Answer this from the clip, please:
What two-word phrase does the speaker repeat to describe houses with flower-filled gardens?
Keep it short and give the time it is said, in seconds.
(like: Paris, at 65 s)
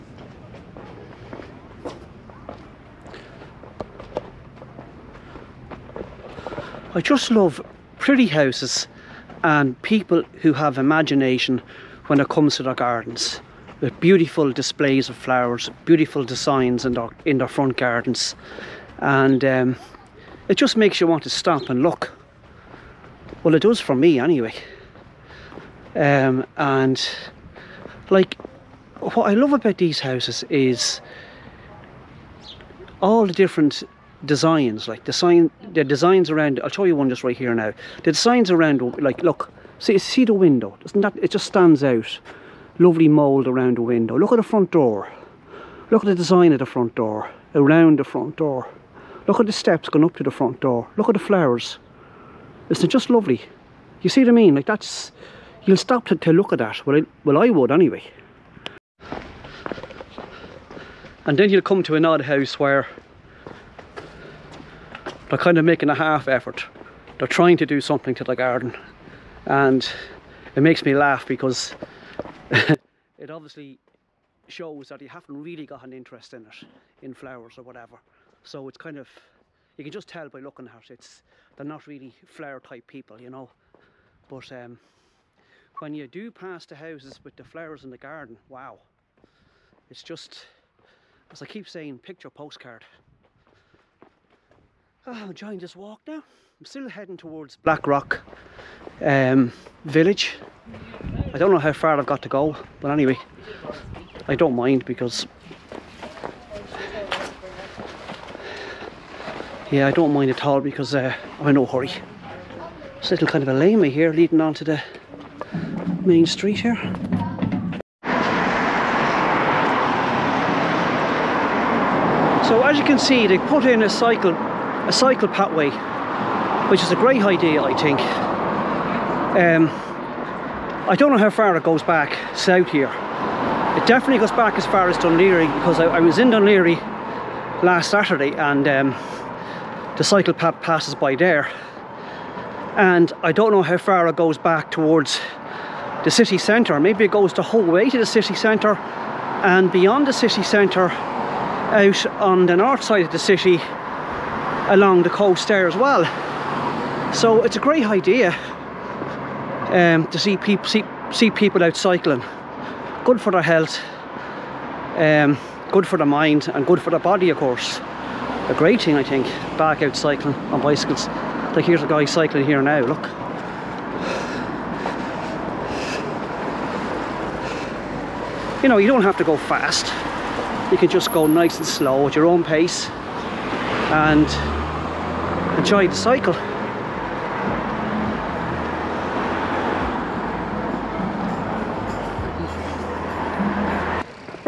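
picture postcard, at 91 s.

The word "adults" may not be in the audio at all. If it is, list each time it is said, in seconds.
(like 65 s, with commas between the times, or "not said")
not said.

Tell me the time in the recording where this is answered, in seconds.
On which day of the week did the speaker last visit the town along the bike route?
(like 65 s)
137 s.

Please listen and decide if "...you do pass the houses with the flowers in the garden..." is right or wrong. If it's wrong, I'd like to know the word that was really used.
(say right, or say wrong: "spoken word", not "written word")
right.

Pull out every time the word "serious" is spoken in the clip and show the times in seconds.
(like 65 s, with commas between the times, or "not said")
not said.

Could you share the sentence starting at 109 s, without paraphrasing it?
Yeah, I don't mind at all because uh, I'm in no hurry.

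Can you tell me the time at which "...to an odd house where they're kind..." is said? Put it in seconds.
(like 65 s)
61 s.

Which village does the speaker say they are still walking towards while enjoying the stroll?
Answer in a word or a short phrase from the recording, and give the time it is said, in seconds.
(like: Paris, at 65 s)
Blackrock, at 97 s.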